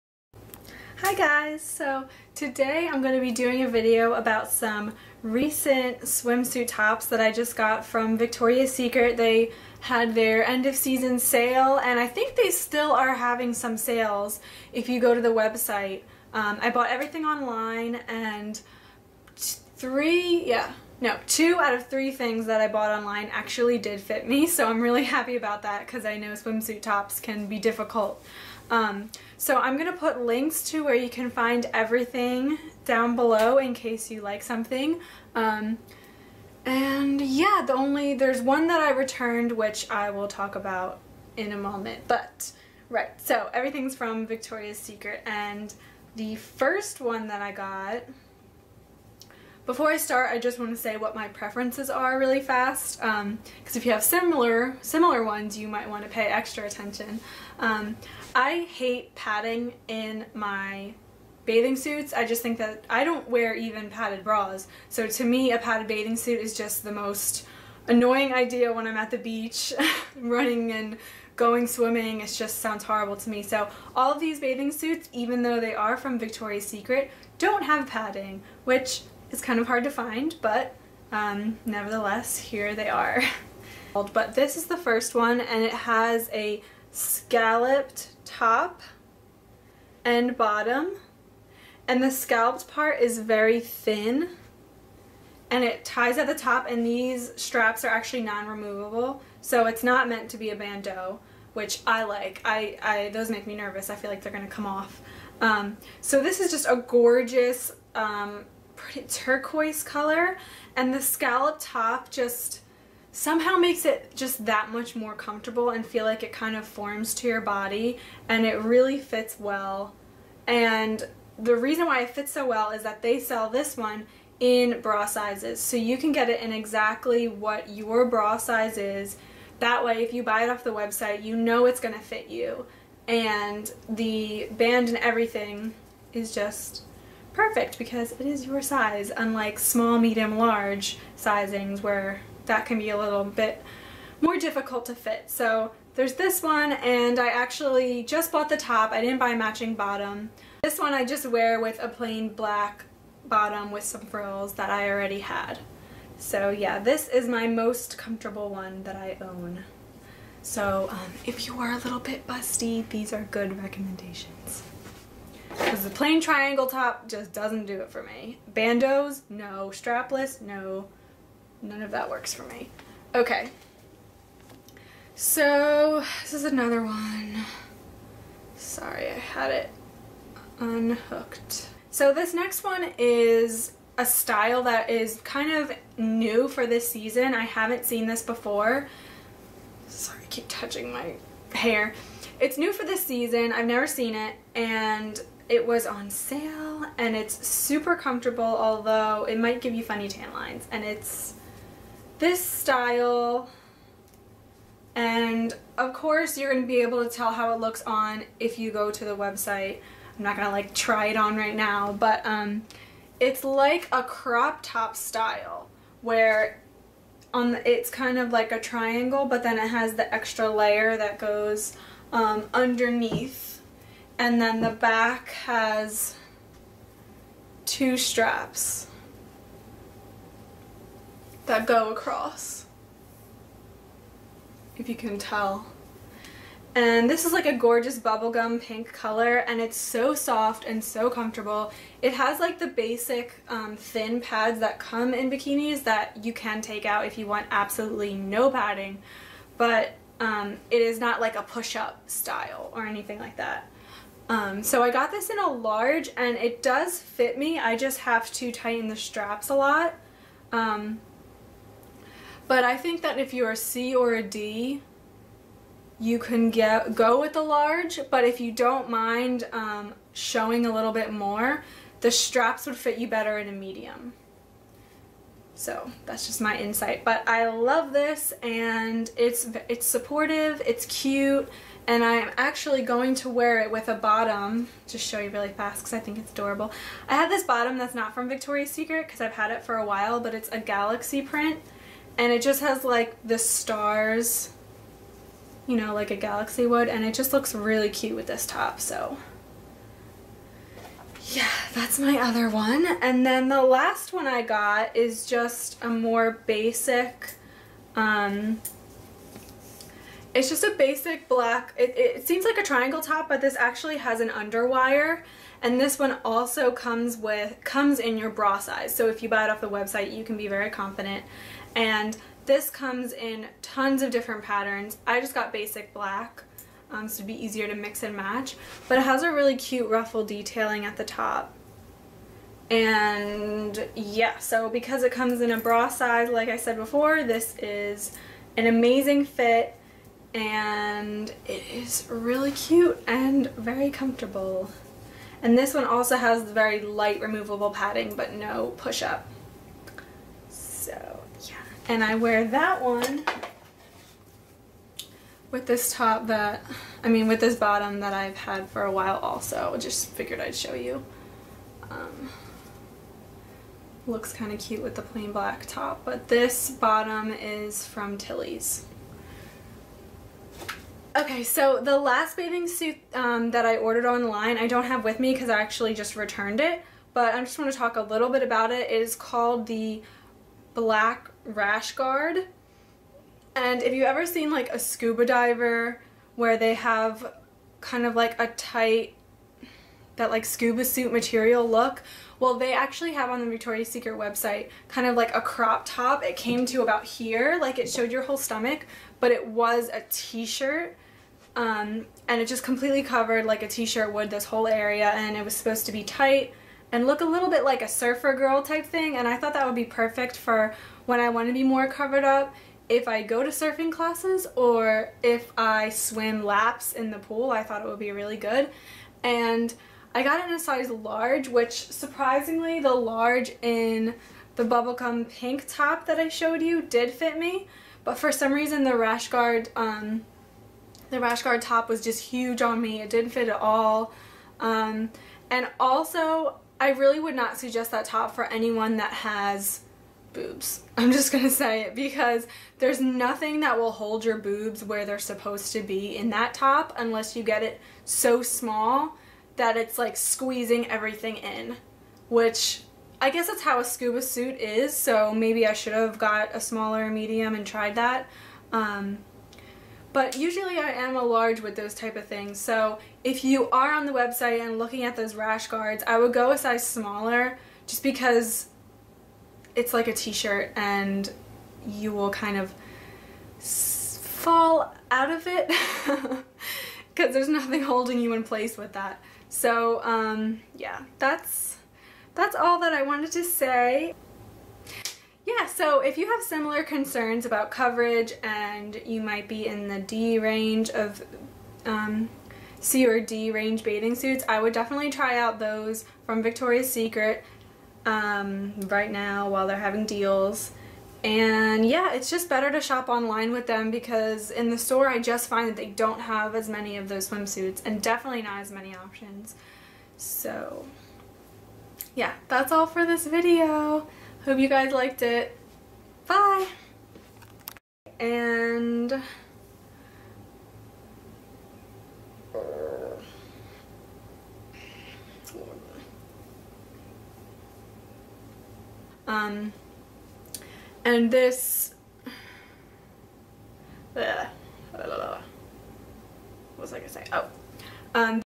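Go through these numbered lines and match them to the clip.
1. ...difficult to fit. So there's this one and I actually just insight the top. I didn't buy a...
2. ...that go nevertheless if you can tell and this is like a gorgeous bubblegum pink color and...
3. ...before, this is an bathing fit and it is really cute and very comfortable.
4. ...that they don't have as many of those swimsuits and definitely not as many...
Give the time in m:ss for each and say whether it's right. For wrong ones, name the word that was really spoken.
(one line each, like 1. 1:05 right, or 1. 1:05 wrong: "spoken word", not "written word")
1. 2:24 wrong: "bought", not "insight"
2. 3:51 wrong: "across", not "nevertheless"
3. 5:36 wrong: "amazing", not "bathing"
4. 8:25 right.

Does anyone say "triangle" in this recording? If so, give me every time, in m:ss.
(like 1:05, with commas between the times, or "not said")
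2:46, 3:38, 5:12.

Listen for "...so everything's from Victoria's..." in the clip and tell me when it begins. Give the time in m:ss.
0:43.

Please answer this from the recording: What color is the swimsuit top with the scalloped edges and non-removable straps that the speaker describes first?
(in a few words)
Turquoise.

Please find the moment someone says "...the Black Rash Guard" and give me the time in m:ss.
6:19.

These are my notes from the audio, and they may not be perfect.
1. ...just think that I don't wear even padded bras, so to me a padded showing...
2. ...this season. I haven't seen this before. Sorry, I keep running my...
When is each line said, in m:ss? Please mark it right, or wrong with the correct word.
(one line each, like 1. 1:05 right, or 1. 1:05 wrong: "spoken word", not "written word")
1. 1:02 wrong: "bathing", not "showing"
2. 3:06 wrong: "touching", not "running".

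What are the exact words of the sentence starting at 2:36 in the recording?
So yeah, this is my most comfortable one that I own.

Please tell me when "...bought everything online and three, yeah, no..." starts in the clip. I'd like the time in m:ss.
0:16.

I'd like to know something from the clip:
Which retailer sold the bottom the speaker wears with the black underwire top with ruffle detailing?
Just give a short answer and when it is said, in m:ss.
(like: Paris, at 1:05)
Tilly's, at 6:08.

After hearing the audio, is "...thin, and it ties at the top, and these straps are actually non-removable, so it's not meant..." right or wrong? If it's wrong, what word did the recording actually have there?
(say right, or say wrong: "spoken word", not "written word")
right.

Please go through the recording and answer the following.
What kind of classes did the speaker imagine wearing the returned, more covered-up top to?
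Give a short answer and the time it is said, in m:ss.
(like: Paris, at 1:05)
Surfing classes, at 6:53.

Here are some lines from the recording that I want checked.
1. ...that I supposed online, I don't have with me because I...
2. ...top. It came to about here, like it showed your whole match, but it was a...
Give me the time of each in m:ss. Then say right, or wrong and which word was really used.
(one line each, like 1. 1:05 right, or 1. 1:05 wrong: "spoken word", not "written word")
1. 6:13 wrong: "ordered", not "supposed"
2. 6:35 wrong: "stomach", not "match".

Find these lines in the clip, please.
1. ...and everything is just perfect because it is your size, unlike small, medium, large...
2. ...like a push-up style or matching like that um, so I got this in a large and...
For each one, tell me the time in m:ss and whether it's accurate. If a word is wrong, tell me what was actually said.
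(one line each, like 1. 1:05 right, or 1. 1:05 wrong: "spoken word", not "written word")
1. 2:14 right
2. 4:11 wrong: "anything", not "matching".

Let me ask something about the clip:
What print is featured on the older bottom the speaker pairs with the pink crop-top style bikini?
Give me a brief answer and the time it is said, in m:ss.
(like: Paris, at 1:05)
Galaxy print, at 4:50.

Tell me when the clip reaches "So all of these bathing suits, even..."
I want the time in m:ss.
1:13.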